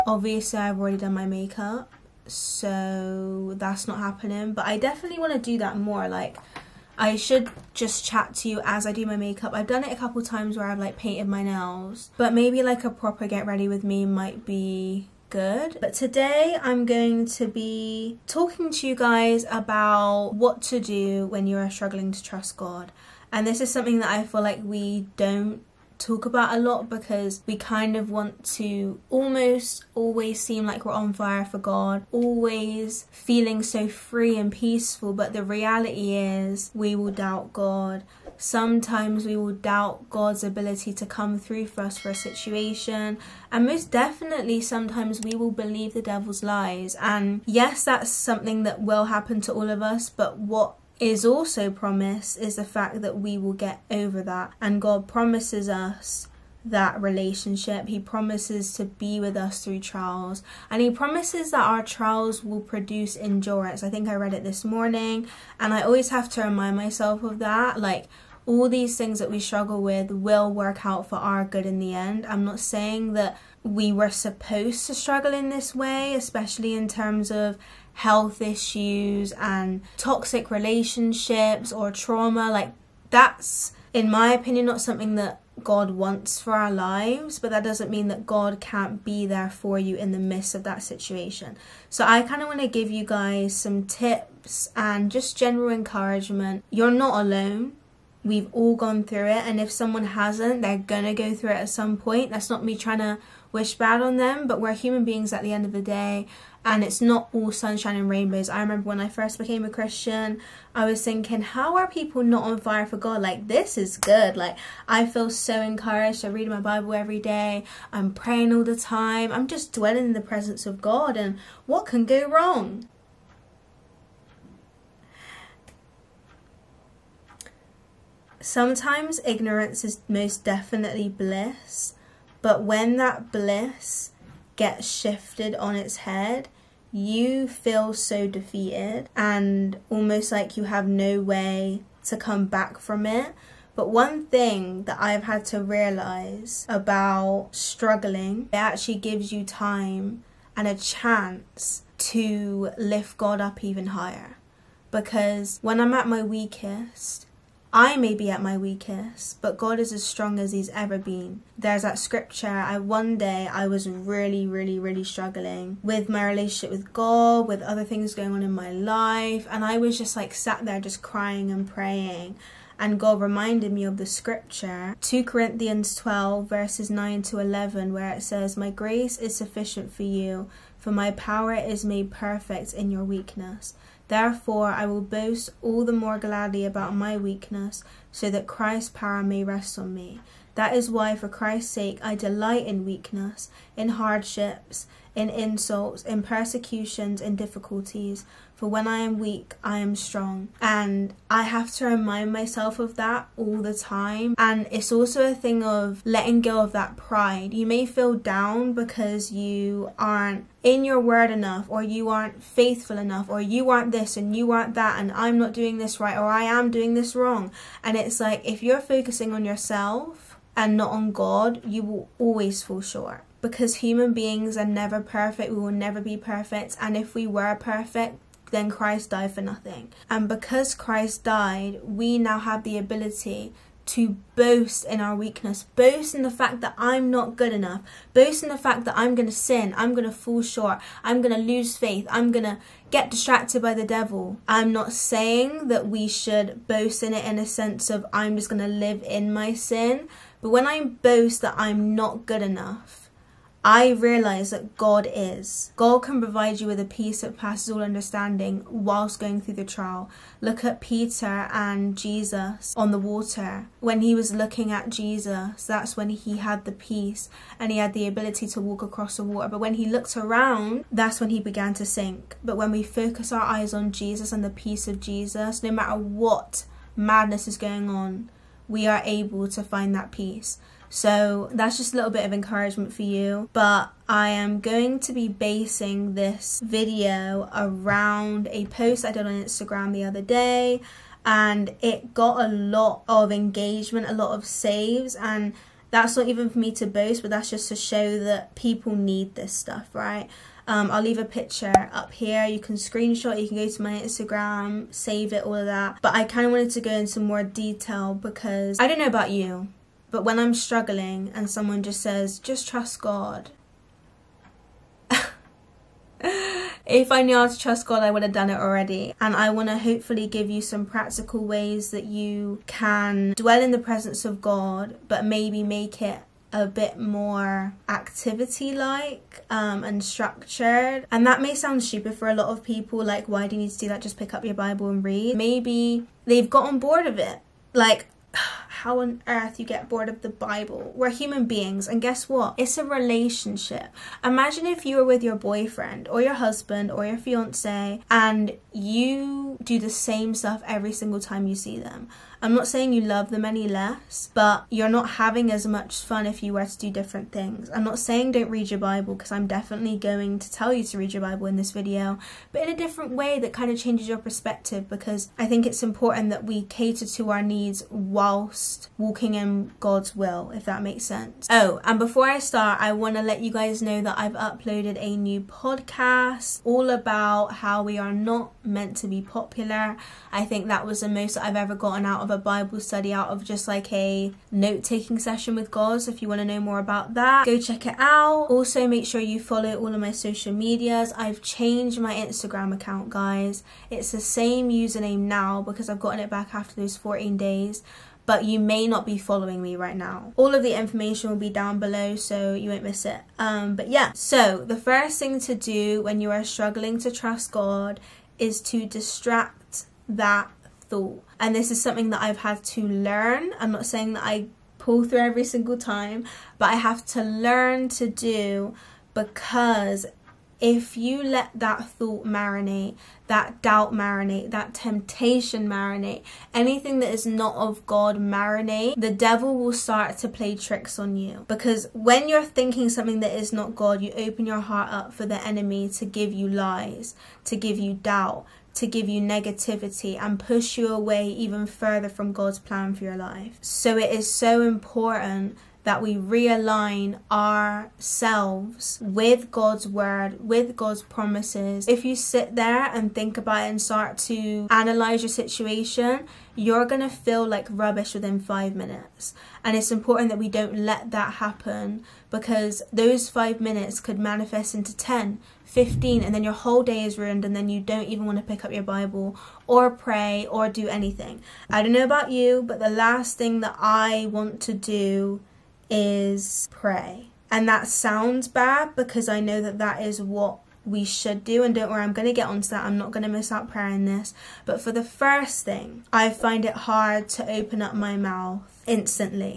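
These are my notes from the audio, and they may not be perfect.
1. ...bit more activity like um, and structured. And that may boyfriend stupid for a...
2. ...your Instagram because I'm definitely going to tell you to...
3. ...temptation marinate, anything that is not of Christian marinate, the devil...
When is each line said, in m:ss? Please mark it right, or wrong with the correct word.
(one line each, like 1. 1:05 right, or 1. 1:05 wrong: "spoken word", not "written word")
1. 5:26 wrong: "sound", not "boyfriend"
2. 5:58 wrong: "Bible", not "Instagram"
3. 7:04 wrong: "God", not "Christian".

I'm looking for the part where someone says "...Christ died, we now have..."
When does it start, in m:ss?
3:50.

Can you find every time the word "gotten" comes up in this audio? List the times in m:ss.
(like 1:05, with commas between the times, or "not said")
5:36, 6:21, 6:35.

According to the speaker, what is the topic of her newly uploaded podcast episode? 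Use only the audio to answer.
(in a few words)
We are not meant to be popular.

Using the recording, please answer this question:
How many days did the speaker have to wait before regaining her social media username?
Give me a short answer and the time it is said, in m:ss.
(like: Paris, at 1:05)
14, at 6:36.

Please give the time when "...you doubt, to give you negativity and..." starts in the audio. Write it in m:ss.
7:17.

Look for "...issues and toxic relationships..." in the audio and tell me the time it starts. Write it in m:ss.
1:18.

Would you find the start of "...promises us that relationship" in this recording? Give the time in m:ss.
0:55.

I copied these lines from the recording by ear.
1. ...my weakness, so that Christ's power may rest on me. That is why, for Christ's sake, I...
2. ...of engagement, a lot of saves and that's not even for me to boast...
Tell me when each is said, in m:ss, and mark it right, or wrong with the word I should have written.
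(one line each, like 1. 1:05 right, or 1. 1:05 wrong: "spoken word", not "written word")
1. 3:06 right
2. 4:53 right.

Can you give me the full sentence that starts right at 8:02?
I'm not going to miss out prayer in this.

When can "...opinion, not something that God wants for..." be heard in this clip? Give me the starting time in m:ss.
1:24.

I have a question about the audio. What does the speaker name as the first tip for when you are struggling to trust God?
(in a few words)
Distract that thought.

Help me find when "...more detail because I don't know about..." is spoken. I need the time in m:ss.
5:07.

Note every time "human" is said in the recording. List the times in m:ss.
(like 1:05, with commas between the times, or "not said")
1:44, 3:43, 5:41.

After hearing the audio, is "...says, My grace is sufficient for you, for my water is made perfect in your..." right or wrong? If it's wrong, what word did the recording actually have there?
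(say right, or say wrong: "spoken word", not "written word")
wrong: "power", not "water".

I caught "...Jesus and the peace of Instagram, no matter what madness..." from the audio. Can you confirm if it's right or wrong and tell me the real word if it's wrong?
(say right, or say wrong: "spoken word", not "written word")
wrong: "Jesus", not "Instagram".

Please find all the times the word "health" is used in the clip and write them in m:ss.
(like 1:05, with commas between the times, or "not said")
1:17.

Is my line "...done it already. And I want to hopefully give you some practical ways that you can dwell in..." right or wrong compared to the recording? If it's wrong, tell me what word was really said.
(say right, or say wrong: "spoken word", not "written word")
right.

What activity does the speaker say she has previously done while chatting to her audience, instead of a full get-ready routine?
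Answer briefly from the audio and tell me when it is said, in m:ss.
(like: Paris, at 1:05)
Painted my nails, at 0:10.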